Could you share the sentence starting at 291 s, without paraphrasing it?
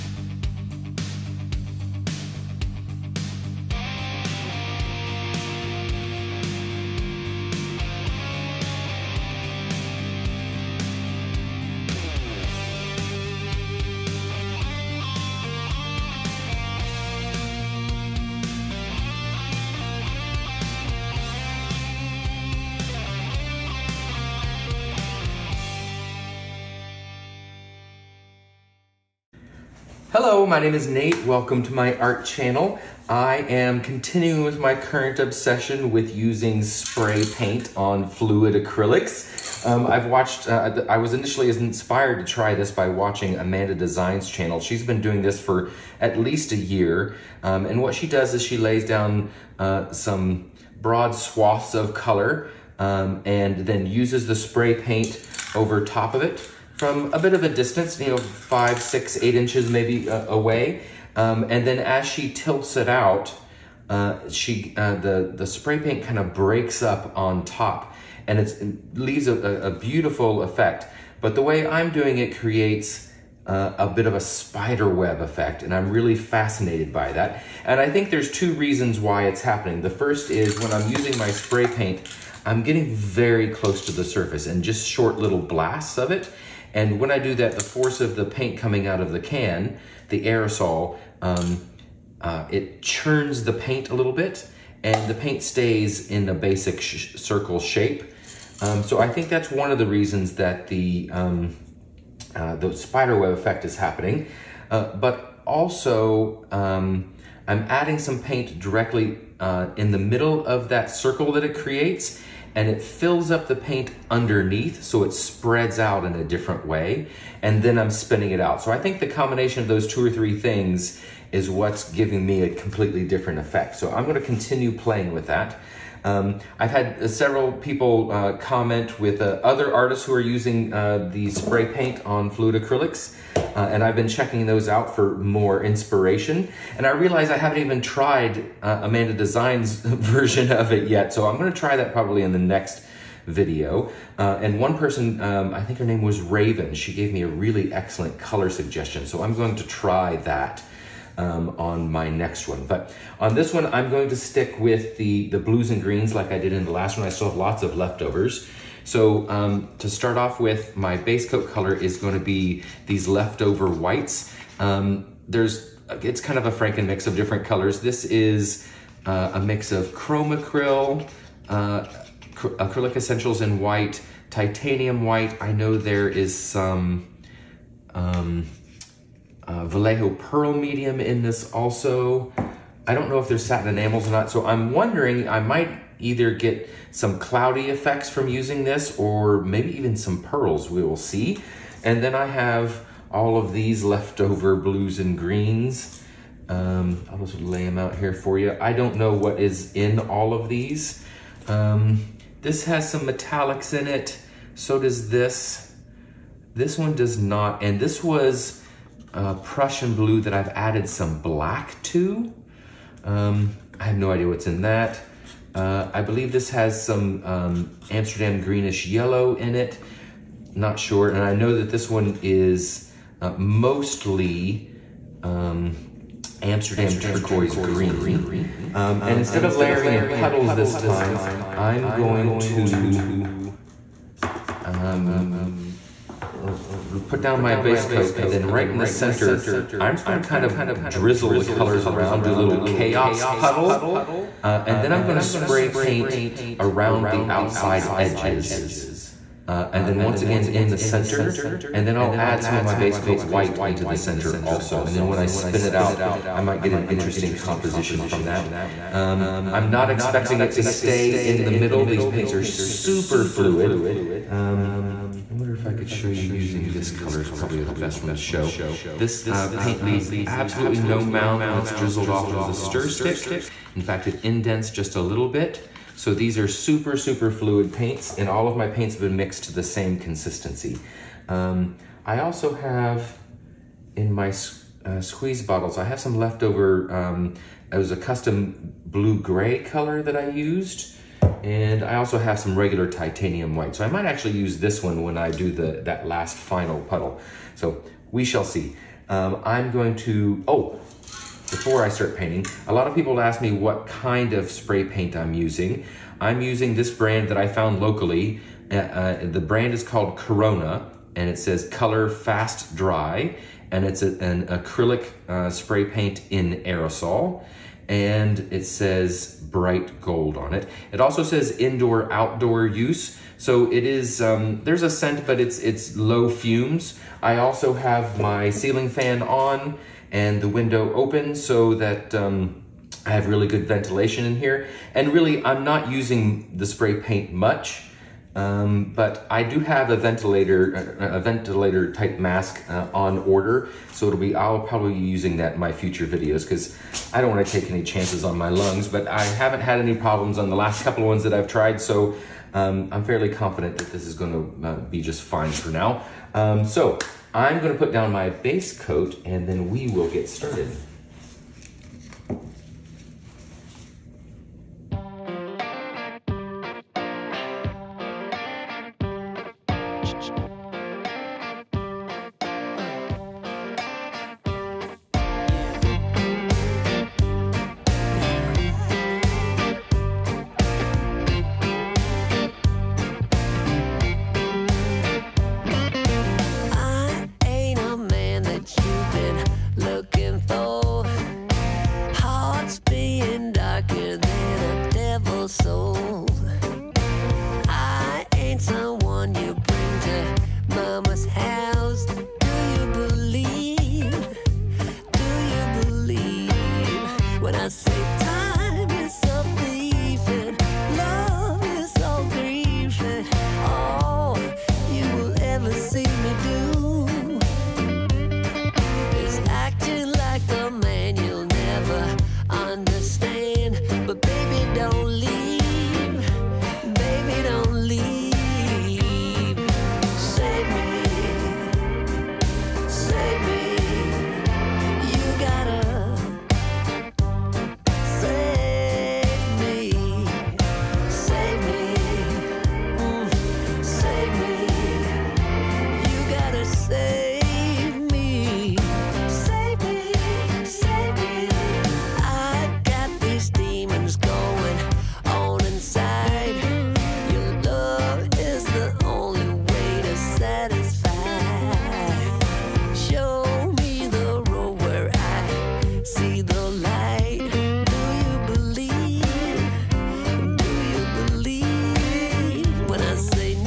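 And I also have some regular titanium white.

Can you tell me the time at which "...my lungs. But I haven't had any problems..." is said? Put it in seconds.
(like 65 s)
348 s.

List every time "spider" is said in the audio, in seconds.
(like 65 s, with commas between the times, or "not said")
74 s, 102 s.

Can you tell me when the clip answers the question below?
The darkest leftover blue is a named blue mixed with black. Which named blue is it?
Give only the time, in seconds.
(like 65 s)
209 s.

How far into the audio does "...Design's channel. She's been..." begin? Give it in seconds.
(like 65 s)
43 s.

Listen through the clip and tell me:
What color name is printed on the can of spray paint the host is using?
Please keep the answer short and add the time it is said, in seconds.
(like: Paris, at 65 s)
bright gold, at 319 s.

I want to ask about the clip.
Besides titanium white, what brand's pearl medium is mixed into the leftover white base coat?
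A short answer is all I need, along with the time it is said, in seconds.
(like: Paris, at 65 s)
Vallejo, at 179 s.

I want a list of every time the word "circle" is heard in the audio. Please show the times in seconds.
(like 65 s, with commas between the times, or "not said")
97 s, 110 s.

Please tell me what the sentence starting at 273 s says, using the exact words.
In fact, it indents just a little bit.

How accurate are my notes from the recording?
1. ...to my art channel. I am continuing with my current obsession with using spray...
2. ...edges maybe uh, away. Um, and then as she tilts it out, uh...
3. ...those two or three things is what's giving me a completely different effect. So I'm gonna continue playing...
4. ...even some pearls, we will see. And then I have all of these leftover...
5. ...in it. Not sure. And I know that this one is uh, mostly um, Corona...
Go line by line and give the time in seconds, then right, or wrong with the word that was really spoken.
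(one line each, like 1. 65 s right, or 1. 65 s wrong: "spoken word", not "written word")
1. 31 s right
2. 59 s wrong: "inches", not "edges"
3. 119 s right
4. 189 s right
5. 219 s wrong: "Amsterdam", not "Corona".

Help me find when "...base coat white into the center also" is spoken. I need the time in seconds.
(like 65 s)
252 s.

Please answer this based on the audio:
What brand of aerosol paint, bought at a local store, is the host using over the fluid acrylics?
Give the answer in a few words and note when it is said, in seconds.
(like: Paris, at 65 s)
Corona, at 310 s.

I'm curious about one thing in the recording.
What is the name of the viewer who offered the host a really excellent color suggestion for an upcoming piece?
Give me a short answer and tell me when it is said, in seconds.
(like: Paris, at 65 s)
Raven, at 146 s.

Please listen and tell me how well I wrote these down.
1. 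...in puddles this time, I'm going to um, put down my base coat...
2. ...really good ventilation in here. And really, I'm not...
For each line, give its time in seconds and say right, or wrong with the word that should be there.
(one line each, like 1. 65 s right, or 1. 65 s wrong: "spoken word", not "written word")
1. 229 s right
2. 333 s right.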